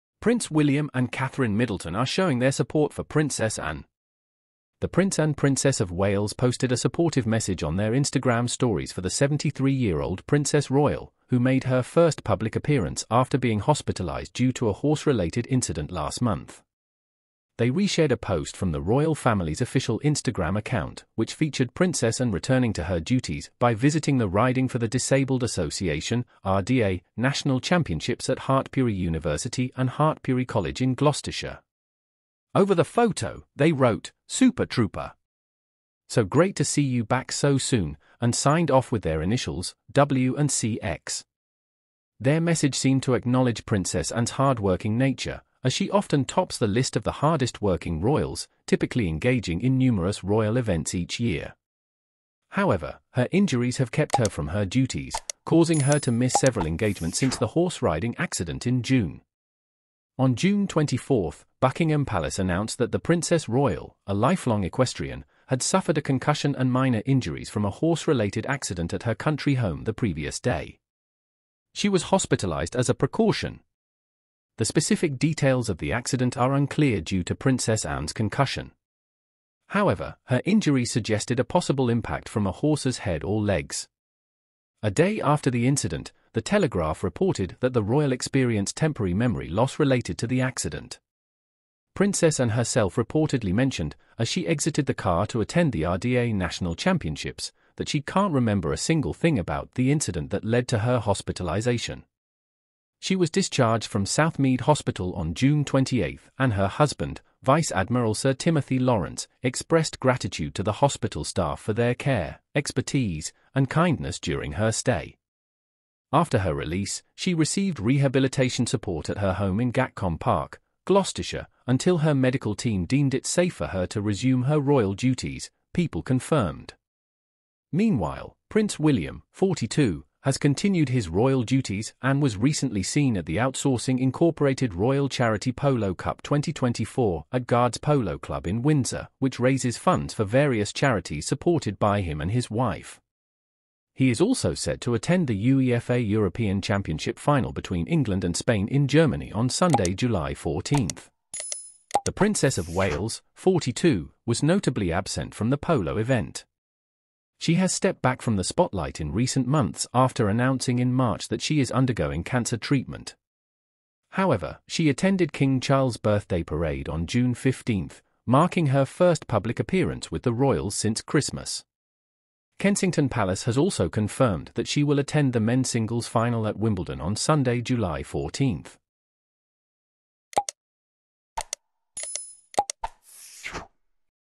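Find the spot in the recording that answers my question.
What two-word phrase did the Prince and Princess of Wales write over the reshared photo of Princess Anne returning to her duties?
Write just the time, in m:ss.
0:34.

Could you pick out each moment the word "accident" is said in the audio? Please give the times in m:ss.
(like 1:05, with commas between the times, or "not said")
0:58, 1:08, 1:15, 1:30.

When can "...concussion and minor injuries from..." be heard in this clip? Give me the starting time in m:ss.
1:06.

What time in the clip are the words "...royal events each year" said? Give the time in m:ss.
0:50.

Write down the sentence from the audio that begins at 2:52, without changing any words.
Kensington Palace has also confirmed that she will attend the men's singles final at Wimbledon on Sunday, July 14.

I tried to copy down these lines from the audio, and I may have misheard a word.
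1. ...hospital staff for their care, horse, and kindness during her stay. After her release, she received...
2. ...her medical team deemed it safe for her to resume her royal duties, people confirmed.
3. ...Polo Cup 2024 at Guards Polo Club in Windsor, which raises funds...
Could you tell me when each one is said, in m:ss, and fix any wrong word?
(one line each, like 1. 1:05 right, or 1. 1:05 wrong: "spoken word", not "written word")
1. 1:50 wrong: "expertise", not "horse"
2. 2:01 right
3. 2:15 right.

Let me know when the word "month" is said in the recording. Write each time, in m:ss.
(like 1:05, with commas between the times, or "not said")
0:16, 2:39.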